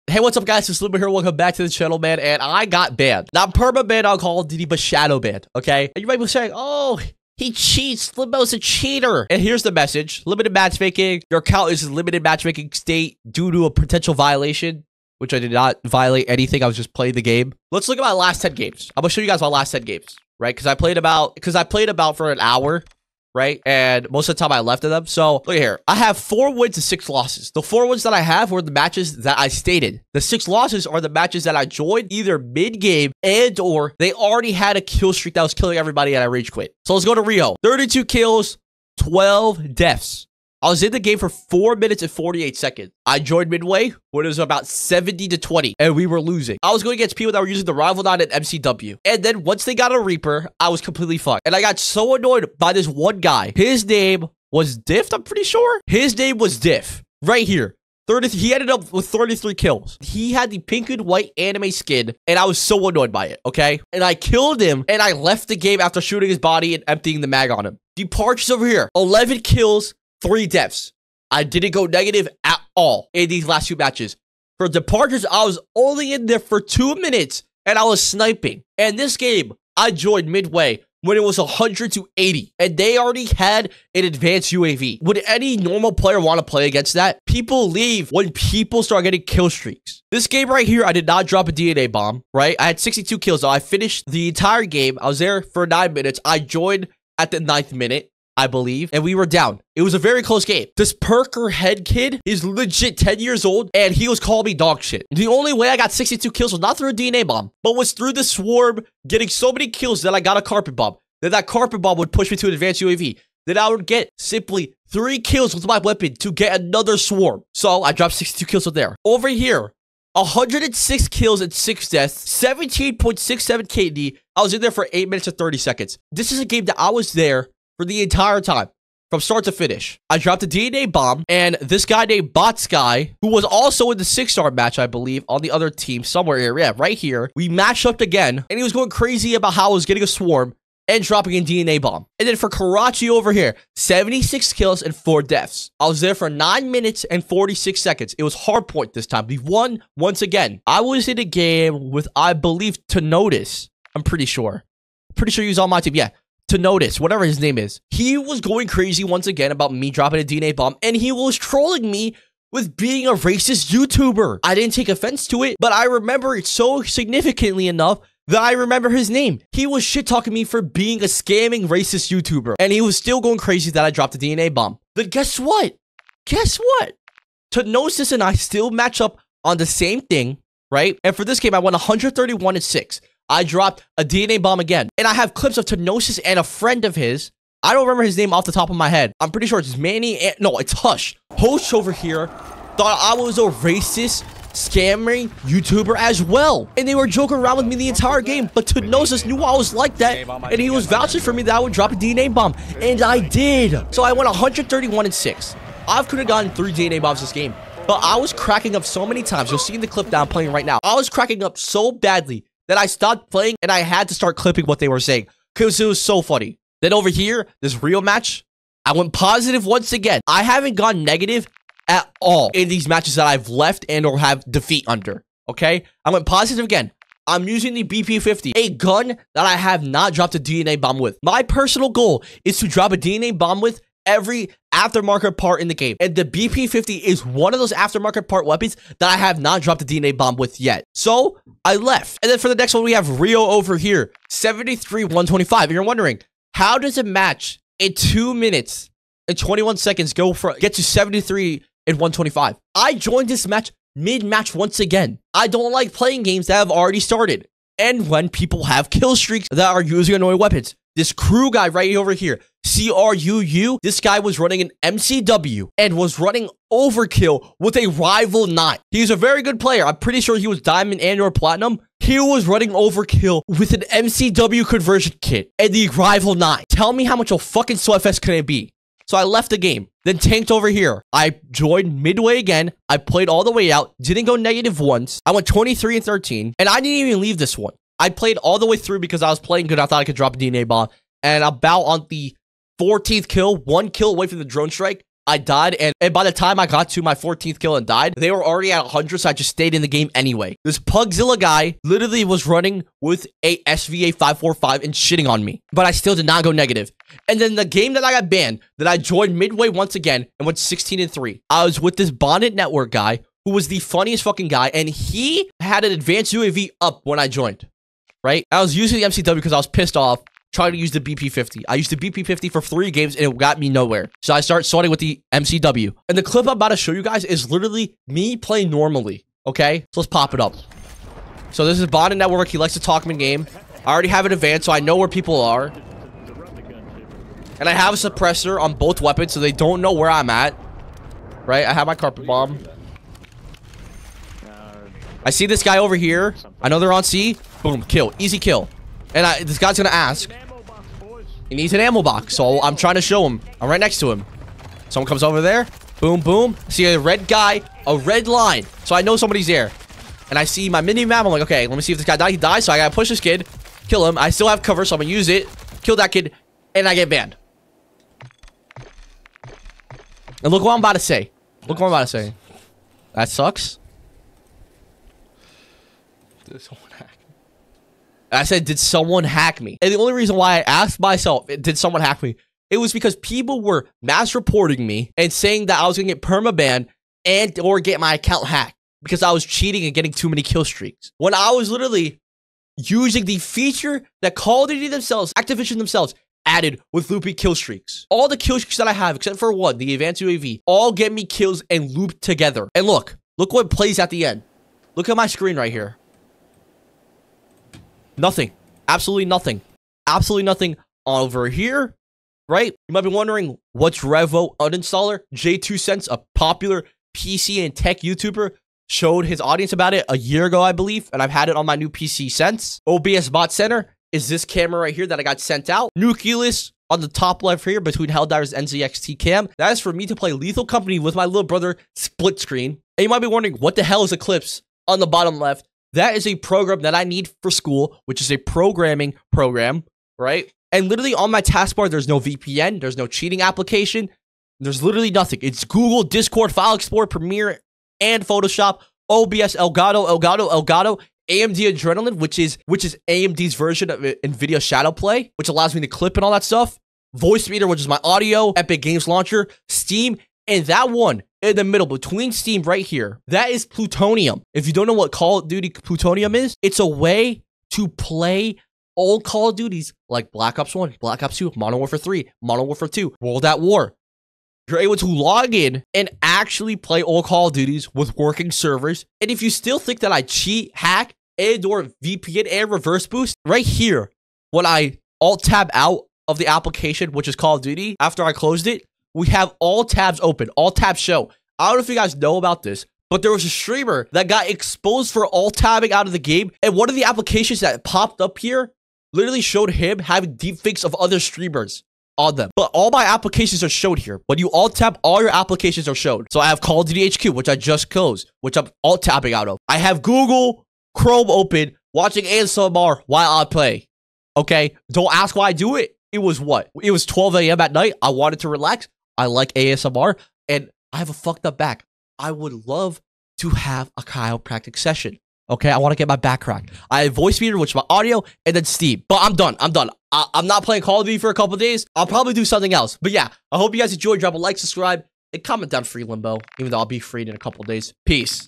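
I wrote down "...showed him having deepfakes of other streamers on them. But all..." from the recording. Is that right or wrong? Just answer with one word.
right.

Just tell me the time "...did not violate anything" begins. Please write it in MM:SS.
00:15.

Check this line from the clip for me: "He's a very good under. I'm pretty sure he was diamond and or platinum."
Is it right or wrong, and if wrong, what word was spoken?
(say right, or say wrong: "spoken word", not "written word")
wrong: "player", not "under".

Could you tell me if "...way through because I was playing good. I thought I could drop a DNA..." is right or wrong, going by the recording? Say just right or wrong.
right.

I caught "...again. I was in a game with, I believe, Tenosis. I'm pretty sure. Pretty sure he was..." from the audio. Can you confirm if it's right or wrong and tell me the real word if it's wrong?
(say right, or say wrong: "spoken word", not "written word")
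right.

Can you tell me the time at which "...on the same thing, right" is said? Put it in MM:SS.
02:59.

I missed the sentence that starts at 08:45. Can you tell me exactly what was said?
Okay, I want to get my back cracked.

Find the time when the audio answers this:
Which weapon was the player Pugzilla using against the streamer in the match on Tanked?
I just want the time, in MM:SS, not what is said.
05:03.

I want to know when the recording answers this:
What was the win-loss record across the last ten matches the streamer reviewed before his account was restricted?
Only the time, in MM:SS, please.
00:26.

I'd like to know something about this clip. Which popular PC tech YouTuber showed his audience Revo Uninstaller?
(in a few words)
JayzTwoCents.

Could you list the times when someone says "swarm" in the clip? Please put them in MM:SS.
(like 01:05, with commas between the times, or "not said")
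01:48, 01:56, 02:20.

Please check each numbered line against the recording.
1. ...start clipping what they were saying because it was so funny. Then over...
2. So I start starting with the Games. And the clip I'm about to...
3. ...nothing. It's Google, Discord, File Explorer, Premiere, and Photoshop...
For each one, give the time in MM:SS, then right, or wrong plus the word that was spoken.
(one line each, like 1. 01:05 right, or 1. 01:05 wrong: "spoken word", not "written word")
1. 03:34 right
2. 05:24 wrong: "MCW", not "Games"
3. 07:25 right.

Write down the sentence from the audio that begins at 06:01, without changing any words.
I'm like, okay, let me see if this guy dies.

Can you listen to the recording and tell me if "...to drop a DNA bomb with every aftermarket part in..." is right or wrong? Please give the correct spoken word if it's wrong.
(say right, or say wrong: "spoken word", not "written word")
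right.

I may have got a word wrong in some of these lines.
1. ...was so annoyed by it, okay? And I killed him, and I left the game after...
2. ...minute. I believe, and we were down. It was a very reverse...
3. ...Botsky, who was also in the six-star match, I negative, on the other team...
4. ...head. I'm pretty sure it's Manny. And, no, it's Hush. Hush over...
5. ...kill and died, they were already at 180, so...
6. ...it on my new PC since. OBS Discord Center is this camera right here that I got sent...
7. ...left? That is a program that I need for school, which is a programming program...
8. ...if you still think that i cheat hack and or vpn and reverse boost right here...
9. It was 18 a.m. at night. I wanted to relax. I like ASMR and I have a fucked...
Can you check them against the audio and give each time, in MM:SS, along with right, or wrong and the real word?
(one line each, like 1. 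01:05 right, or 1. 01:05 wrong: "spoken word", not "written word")
1. 01:02 right
2. 01:37 wrong: "close", not "reverse"
3. 02:12 wrong: "believe", not "negative"
4. 03:08 right
5. 04:57 wrong: "100", not "180"
6. 07:01 wrong: "Bot", not "Discord"
7. 07:15 right
8. 07:59 right
9. 08:36 wrong: "12", not "18".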